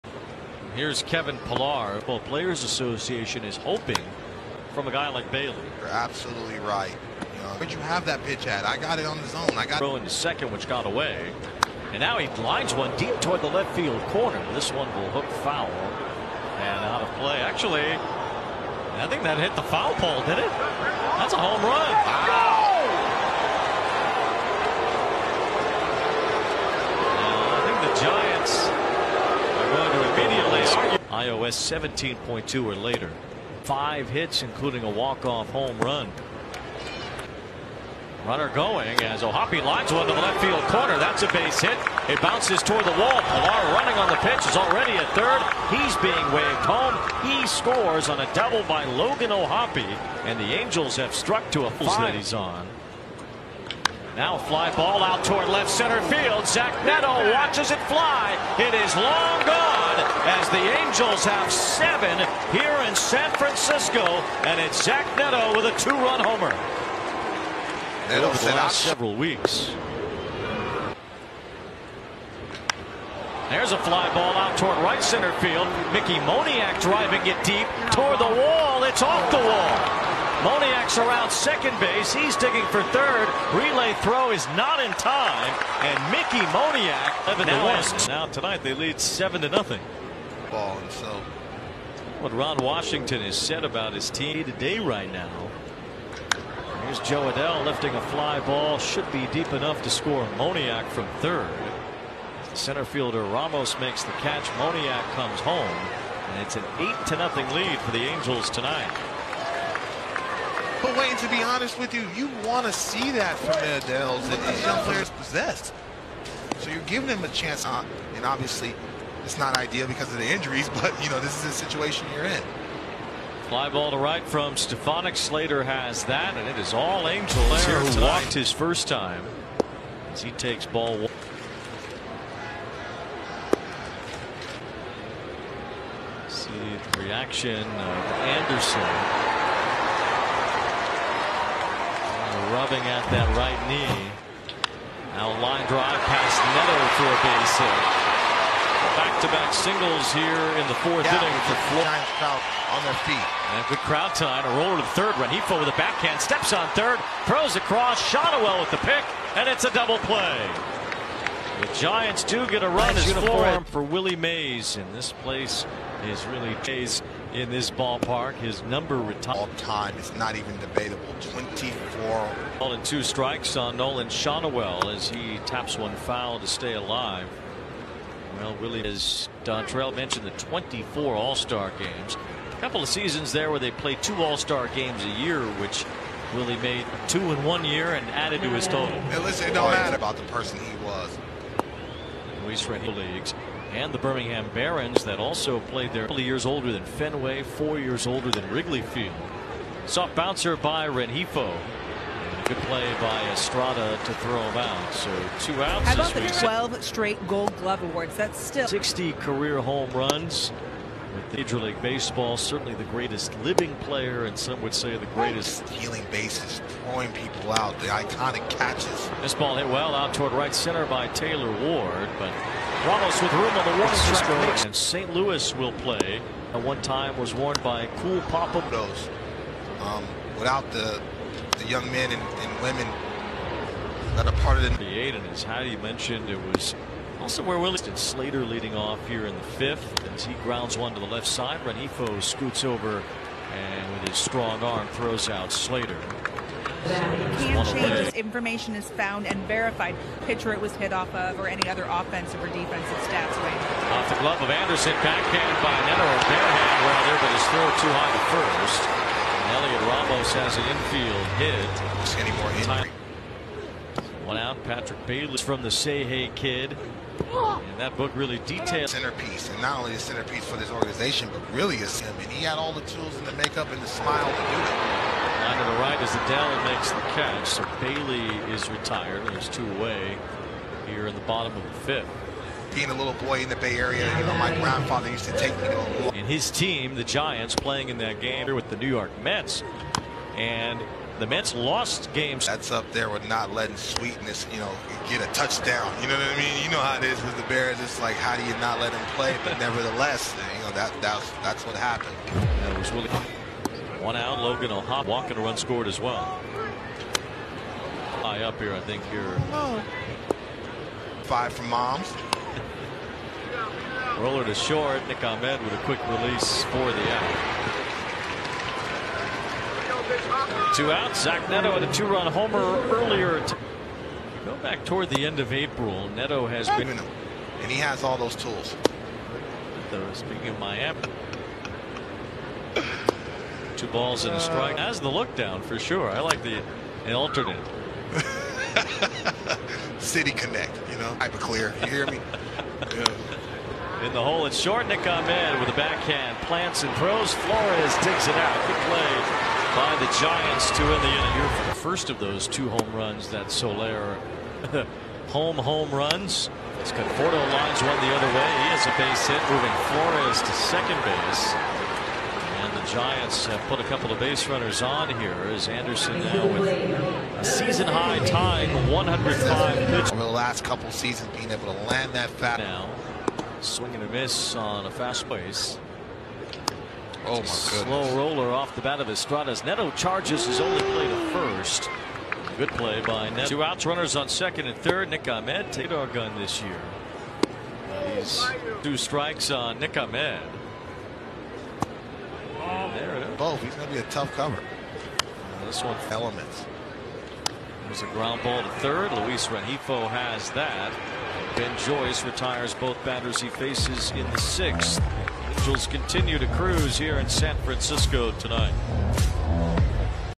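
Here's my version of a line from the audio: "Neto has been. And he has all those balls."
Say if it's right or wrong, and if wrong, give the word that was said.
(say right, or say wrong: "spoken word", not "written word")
wrong: "tools", not "balls".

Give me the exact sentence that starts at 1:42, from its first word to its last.
Center fielder Ramos makes the catch.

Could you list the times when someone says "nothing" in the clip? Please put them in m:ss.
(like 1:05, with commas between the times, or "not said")
1:29, 1:47.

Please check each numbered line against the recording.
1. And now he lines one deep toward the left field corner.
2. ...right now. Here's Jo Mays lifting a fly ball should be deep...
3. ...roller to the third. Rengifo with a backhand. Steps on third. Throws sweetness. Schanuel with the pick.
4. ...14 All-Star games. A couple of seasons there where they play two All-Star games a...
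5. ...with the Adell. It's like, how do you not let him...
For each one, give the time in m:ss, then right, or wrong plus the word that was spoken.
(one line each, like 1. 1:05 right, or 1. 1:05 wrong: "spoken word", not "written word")
1. 0:11 right
2. 1:34 wrong: "Adell", not "Mays"
3. 2:34 wrong: "across", not "sweetness"
4. 3:00 wrong: "24", not "14"
5. 4:57 wrong: "Bears", not "Adell".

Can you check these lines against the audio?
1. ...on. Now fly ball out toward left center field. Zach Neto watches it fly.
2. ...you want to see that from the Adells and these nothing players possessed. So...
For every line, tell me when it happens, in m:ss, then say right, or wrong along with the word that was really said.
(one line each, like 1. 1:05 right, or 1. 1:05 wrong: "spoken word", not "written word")
1. 0:52 right
2. 1:52 wrong: "young", not "nothing".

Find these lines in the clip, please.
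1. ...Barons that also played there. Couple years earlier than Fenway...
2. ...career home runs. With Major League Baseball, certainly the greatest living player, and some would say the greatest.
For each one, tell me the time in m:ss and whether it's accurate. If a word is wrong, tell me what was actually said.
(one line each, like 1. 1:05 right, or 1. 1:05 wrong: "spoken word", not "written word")
1. 3:14 wrong: "older", not "earlier"
2. 3:29 right.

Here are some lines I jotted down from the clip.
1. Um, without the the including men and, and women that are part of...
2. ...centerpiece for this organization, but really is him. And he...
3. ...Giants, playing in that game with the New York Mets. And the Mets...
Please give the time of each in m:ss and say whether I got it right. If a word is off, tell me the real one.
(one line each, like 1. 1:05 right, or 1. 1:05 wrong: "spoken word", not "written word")
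1. 3:49 wrong: "young", not "including"
2. 4:29 right
3. 4:47 right.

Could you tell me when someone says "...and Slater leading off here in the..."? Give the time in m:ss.
3:57.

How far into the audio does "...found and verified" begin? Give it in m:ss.
4:08.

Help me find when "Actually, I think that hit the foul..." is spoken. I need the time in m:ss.
0:17.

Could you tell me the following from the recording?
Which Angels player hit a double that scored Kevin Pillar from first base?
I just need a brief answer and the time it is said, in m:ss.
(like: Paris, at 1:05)
Logan O'Hoppe, at 0:48.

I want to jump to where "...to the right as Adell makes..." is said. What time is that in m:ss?
4:35.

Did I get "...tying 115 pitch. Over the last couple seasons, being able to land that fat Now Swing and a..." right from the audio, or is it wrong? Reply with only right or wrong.
wrong.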